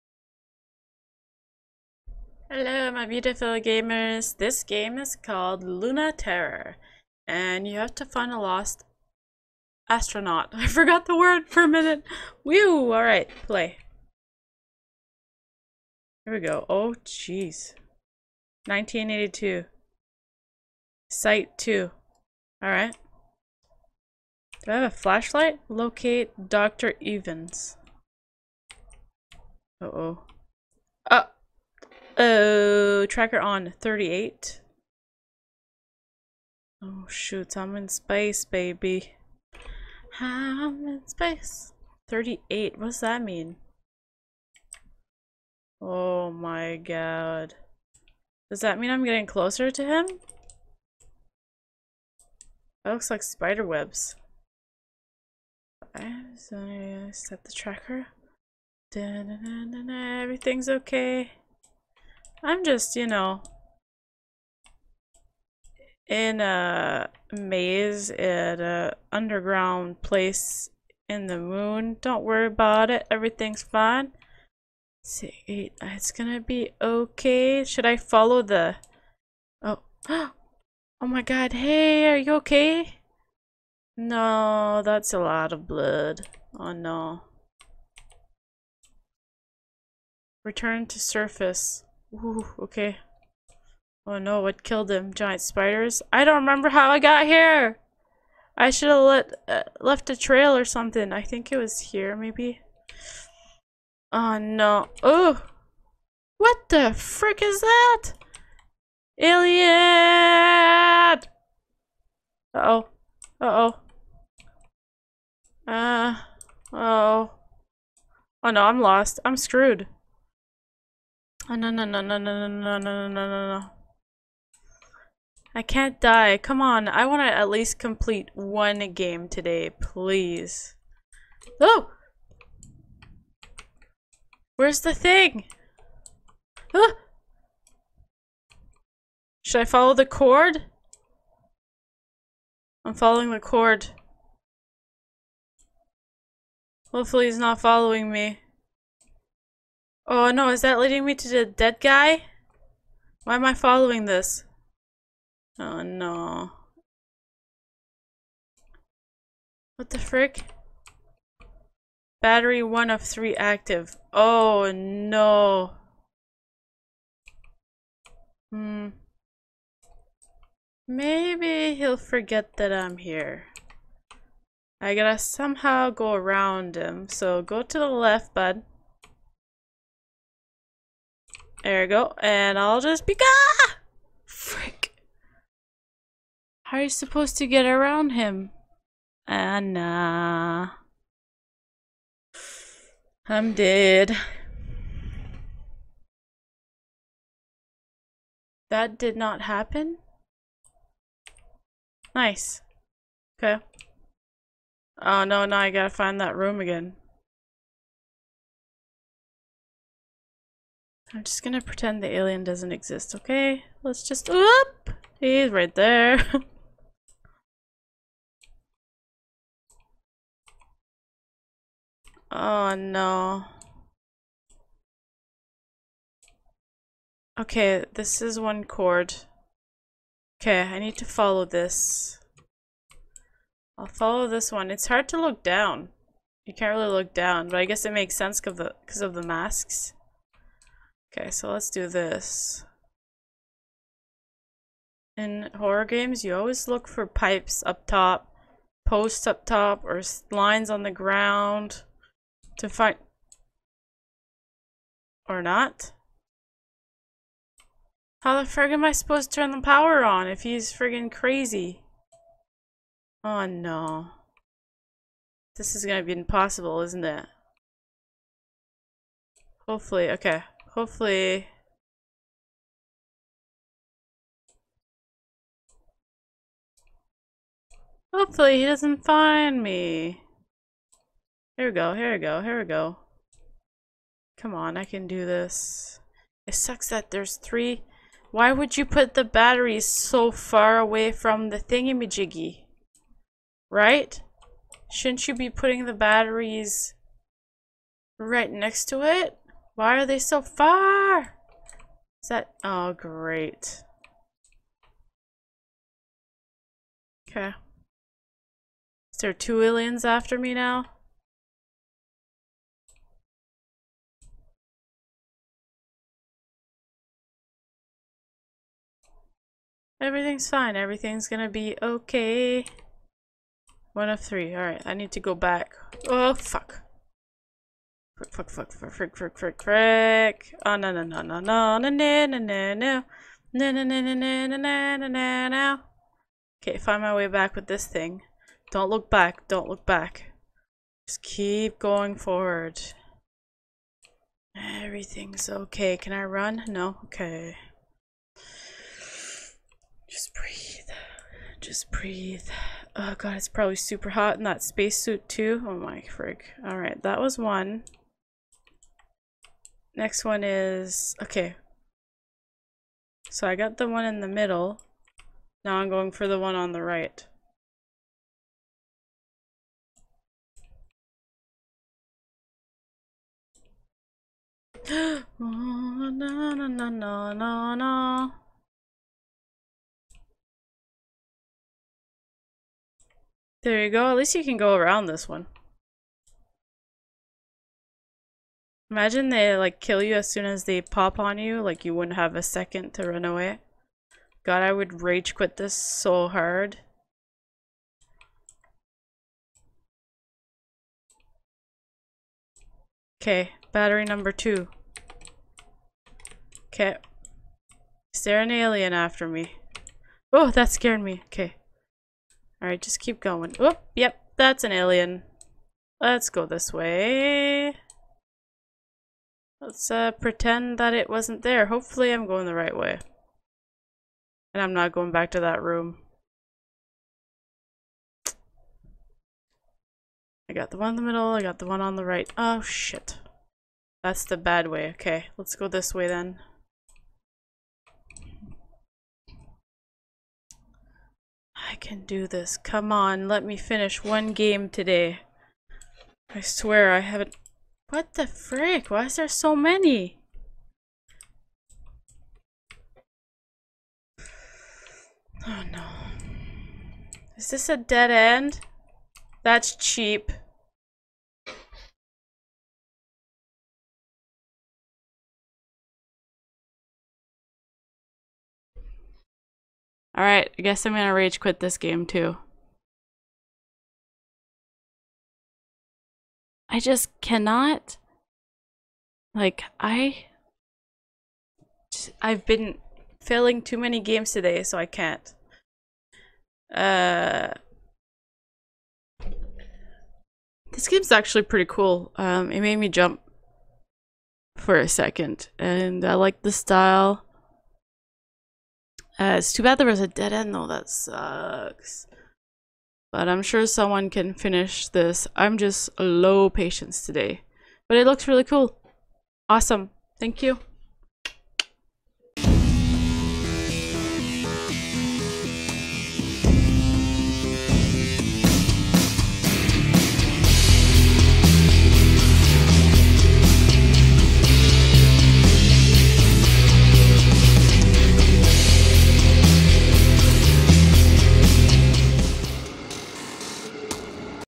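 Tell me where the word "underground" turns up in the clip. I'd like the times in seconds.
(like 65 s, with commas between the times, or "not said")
69 s.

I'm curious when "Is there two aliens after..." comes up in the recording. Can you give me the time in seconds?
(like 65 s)
309 s.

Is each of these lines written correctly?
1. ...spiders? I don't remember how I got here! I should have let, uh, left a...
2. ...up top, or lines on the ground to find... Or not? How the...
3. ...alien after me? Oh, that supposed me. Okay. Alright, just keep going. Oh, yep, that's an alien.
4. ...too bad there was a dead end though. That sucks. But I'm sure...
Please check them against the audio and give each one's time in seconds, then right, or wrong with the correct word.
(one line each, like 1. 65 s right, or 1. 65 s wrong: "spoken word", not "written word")
1. 95 s right
2. 249 s right
3. 408 s wrong: "scared", not "supposed"
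4. 499 s right.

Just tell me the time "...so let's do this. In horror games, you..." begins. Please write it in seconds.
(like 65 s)
241 s.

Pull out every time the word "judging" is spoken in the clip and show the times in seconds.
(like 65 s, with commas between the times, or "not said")
not said.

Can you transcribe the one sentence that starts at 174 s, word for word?
I gotta somehow go around him, so go to the left, bud.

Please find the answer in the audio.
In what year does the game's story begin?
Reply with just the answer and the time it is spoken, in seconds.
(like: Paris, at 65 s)
1982, at 18 s.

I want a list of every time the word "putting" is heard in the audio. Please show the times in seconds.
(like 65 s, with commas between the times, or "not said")
295 s.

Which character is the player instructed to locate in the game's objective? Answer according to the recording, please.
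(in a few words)
Dr. Evans.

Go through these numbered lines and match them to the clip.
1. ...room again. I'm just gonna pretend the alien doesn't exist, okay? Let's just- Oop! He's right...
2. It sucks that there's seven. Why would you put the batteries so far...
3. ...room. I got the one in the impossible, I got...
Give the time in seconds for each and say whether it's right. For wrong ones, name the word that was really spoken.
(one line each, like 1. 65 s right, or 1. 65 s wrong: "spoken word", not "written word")
1. 206 s right
2. 286 s wrong: "three", not "seven"
3. 425 s wrong: "middle", not "impossible".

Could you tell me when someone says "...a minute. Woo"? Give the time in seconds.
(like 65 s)
11 s.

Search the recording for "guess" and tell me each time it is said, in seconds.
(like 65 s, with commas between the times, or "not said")
237 s, 470 s.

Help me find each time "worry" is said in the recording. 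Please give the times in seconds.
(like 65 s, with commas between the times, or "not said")
72 s.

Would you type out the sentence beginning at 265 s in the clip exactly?
This is gonna be impossible, isn't it?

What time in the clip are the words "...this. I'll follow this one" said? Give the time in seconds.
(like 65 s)
231 s.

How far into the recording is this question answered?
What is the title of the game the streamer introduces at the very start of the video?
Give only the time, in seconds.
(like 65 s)
5 s.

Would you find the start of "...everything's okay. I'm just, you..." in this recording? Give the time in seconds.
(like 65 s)
60 s.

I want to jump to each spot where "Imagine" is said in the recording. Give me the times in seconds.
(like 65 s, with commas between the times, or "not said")
388 s.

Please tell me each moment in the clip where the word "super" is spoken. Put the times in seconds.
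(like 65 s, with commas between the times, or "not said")
353 s.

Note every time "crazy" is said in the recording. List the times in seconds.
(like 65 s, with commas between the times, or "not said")
261 s.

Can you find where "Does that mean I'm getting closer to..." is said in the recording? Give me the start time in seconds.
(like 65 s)
48 s.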